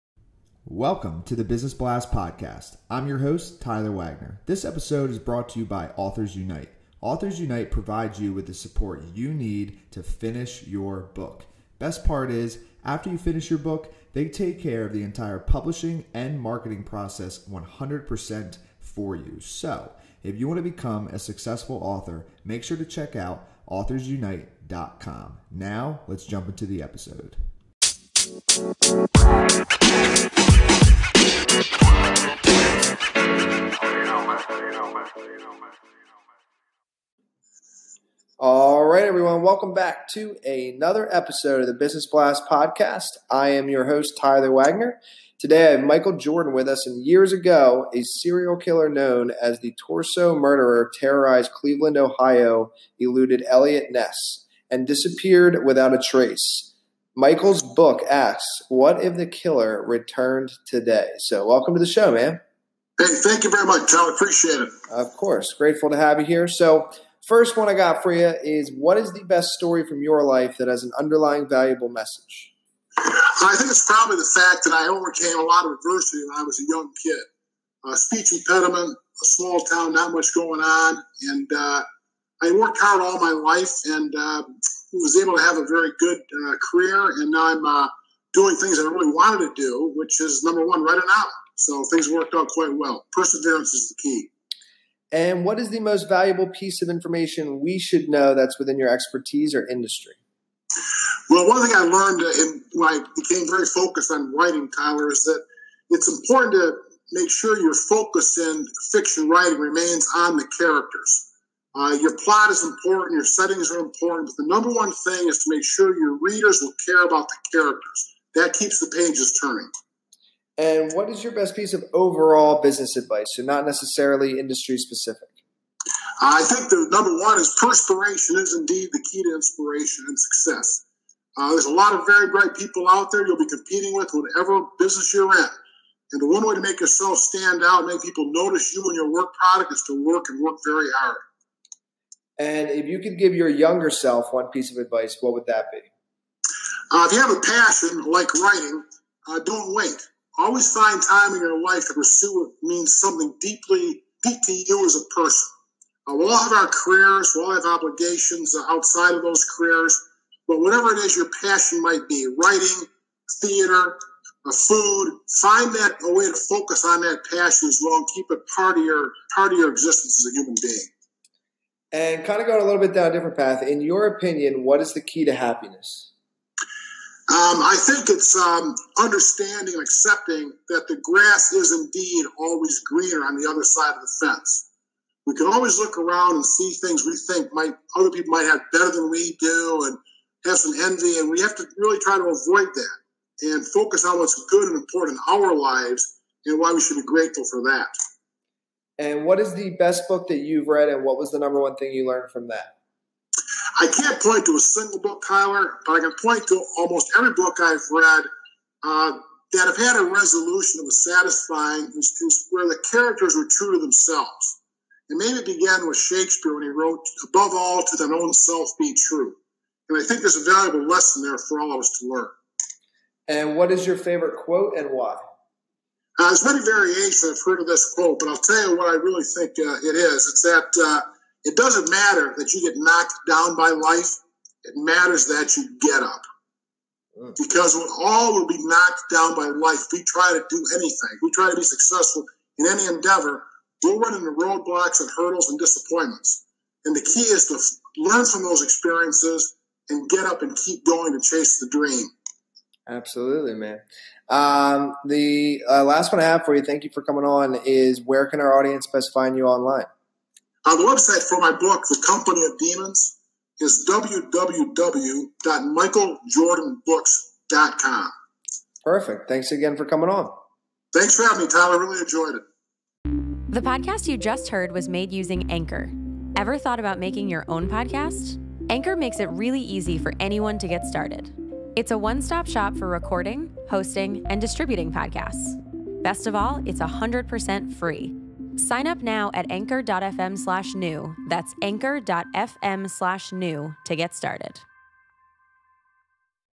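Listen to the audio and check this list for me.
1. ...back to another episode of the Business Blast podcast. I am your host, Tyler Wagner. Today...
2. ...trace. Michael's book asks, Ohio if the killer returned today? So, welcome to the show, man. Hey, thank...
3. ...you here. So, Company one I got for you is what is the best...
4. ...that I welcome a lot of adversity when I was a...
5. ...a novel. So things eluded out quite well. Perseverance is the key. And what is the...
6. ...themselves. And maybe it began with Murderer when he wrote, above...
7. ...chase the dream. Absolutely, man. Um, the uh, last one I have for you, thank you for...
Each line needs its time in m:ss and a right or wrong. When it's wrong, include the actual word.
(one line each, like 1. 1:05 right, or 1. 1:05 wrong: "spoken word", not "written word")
1. 0:39 right
2. 0:56 wrong: "What", not "Ohio"
3. 1:06 wrong: "First", not "Company"
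4. 1:14 wrong: "overcame", not "welcome"
5. 1:30 wrong: "worked", not "eluded"
6. 3:33 wrong: "Shakespeare", not "Murderer"
7. 4:11 right.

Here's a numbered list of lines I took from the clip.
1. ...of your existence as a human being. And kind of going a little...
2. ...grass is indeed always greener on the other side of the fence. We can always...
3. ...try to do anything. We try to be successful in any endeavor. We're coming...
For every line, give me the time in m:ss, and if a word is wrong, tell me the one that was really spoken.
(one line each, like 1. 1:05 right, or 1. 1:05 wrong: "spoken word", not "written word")
1. 2:49 right
2. 3:00 right
3. 4:00 wrong: "running", not "coming".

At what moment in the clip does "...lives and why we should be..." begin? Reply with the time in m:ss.
3:15.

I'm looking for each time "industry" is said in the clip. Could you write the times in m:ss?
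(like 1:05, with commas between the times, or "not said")
1:39, 2:04.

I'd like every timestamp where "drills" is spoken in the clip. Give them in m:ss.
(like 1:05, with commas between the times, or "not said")
not said.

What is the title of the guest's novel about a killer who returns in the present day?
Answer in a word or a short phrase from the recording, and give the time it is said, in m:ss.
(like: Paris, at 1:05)
The Company of Demons, at 4:21.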